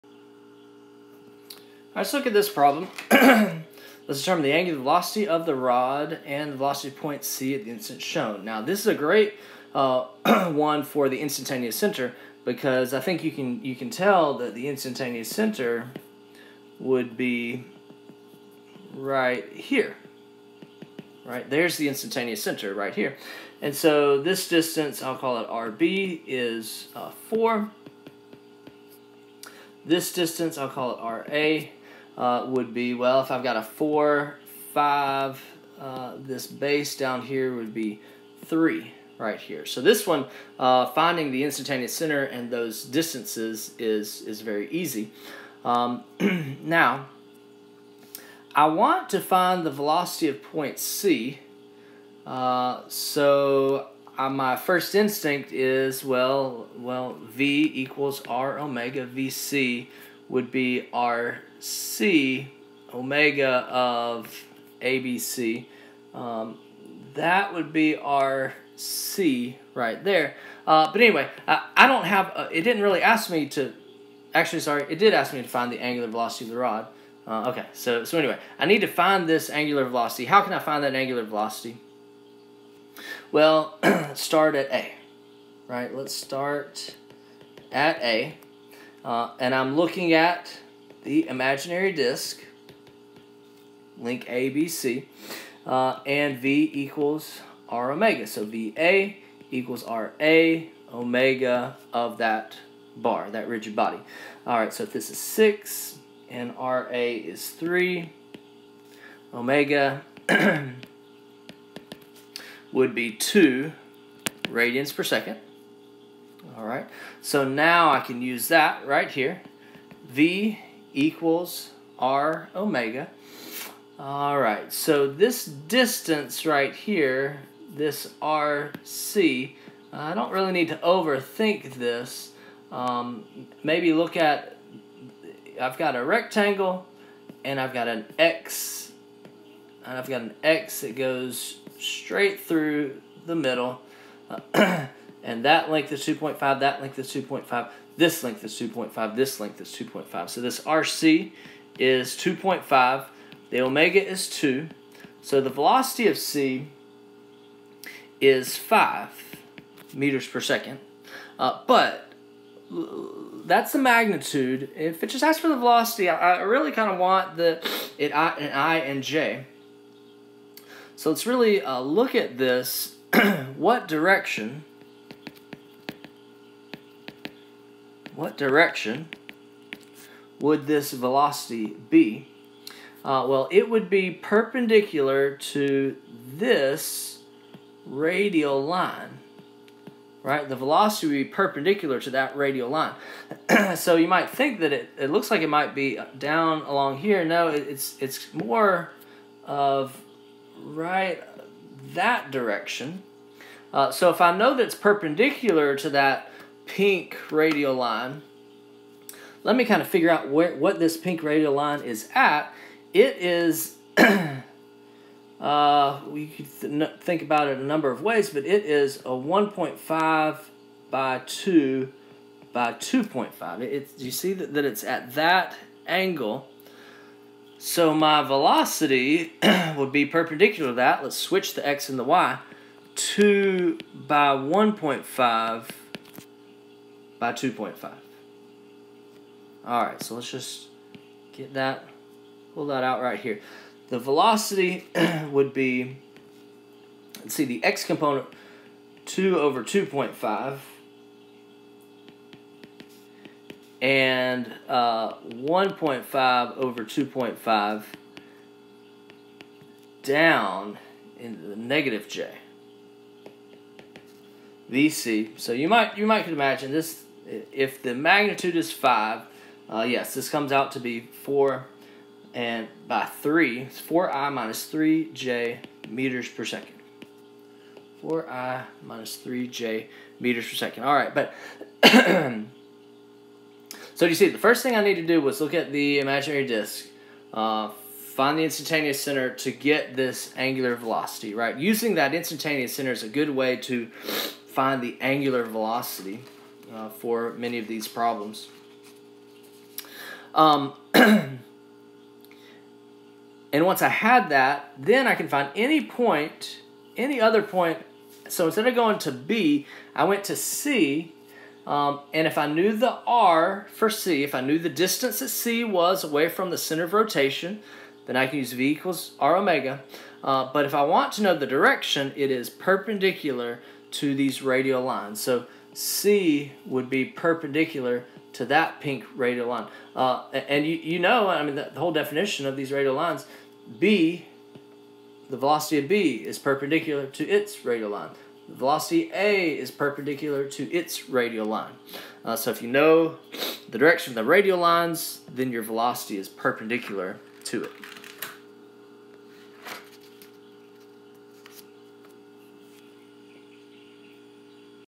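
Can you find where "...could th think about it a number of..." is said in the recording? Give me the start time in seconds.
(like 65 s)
216 s.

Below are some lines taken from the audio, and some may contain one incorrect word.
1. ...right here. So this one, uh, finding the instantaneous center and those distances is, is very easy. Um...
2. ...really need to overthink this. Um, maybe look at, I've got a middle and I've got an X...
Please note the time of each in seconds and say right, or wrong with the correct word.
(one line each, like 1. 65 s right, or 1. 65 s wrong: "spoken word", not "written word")
1. 39 s right
2. 130 s wrong: "rectangle", not "middle".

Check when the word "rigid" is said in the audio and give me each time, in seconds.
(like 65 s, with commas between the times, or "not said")
103 s.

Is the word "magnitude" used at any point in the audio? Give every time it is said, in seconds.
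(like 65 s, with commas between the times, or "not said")
163 s, 267 s.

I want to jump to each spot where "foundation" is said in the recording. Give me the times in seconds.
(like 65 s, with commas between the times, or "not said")
not said.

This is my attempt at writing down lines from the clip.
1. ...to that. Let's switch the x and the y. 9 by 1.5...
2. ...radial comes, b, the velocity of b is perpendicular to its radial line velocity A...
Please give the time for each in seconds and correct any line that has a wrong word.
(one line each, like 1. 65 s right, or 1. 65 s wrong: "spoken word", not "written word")
1. 230 s wrong: "2", not "9"
2. 332 s wrong: "lines", not "comes".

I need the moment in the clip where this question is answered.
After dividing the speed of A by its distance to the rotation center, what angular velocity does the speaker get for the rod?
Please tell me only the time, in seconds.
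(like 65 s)
113 s.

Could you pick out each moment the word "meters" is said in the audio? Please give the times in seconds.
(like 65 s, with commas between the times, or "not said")
159 s, 275 s, 280 s.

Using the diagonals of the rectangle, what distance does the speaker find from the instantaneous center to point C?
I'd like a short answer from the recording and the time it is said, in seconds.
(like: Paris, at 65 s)
2.5, at 150 s.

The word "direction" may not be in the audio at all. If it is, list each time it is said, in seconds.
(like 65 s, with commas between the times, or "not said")
173 s, 178 s, 202 s, 321 s, 343 s.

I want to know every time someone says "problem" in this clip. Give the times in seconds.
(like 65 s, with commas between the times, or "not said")
2 s, 297 s.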